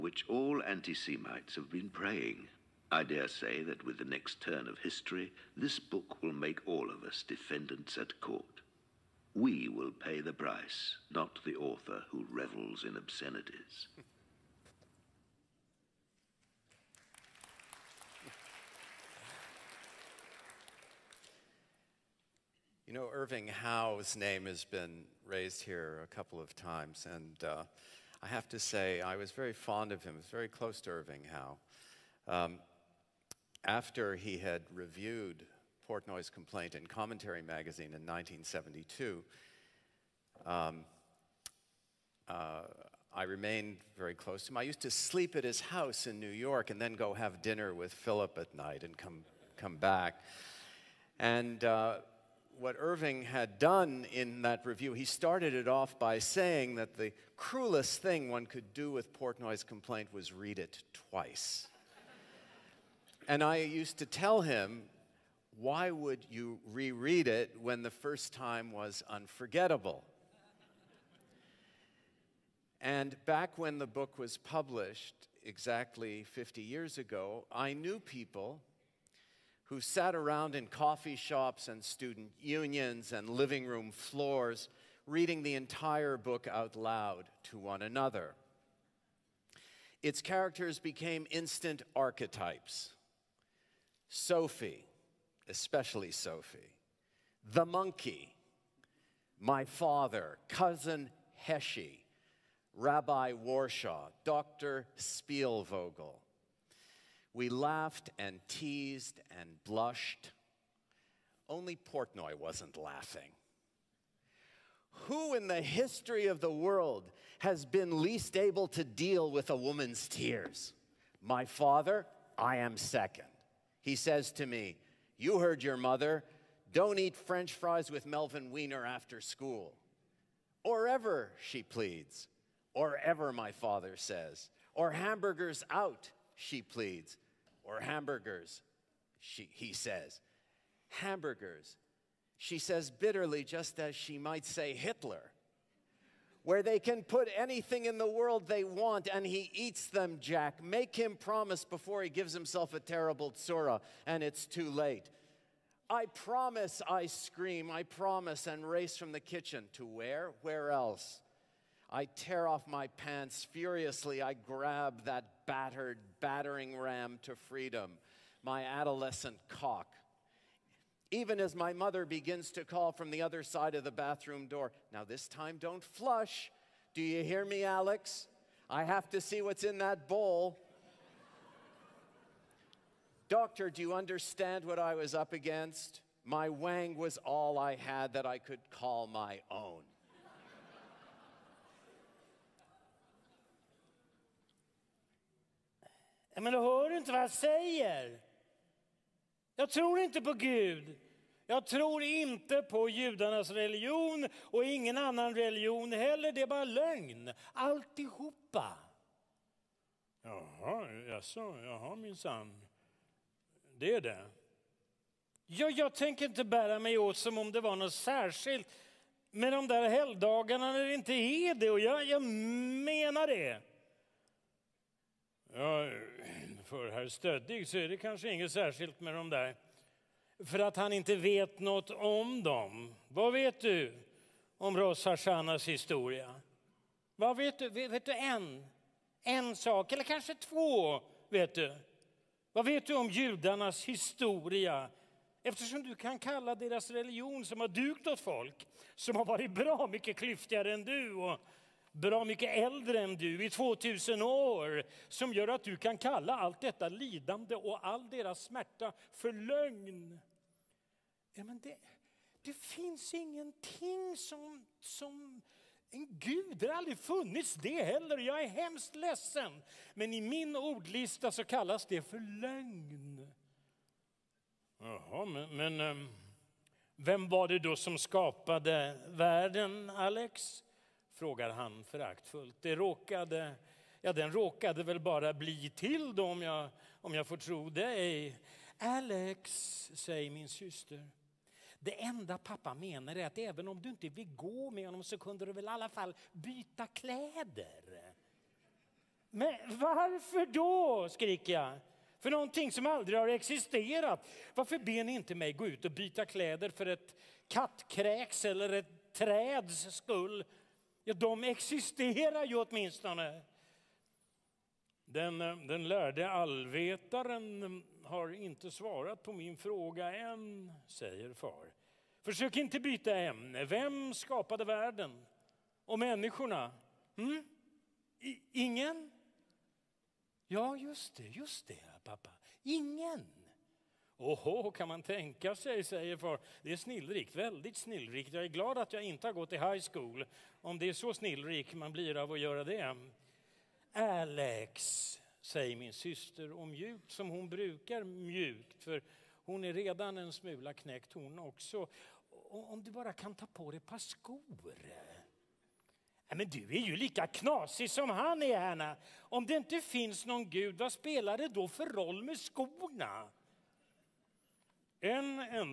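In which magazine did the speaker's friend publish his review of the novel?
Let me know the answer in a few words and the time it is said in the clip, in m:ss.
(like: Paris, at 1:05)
Commentary, at 0:36.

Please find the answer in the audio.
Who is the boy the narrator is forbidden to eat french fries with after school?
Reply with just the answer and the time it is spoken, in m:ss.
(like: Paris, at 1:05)
Melvin Weiner, at 2:08.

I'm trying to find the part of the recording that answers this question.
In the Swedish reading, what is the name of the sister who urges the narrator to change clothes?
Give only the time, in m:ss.
5:58.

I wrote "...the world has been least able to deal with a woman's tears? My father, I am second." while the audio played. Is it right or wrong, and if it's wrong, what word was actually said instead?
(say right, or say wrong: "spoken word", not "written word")
right.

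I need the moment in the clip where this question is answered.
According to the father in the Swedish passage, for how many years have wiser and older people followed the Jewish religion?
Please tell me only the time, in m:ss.
4:13.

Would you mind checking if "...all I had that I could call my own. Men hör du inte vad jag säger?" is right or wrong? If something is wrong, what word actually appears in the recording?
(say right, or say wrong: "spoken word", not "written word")
right.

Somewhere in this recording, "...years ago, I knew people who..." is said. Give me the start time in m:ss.
1:16.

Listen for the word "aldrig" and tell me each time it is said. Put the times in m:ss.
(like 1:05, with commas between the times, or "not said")
4:26, 5:02.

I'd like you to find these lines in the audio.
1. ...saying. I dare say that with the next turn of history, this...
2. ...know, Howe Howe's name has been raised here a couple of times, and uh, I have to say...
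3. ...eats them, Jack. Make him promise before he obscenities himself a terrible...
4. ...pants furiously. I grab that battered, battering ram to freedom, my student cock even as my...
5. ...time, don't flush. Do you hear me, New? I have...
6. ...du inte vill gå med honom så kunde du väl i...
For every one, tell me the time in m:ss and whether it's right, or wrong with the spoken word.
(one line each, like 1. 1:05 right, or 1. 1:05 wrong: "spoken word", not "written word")
1. 0:01 wrong: "praying", not "saying"
2. 0:22 wrong: "Irving", not "Howe"
3. 2:29 wrong: "gives", not "obscenities"
4. 2:42 wrong: "adolescent", not "student"
5. 2:55 wrong: "Alex", not "New"
6. 4:53 right.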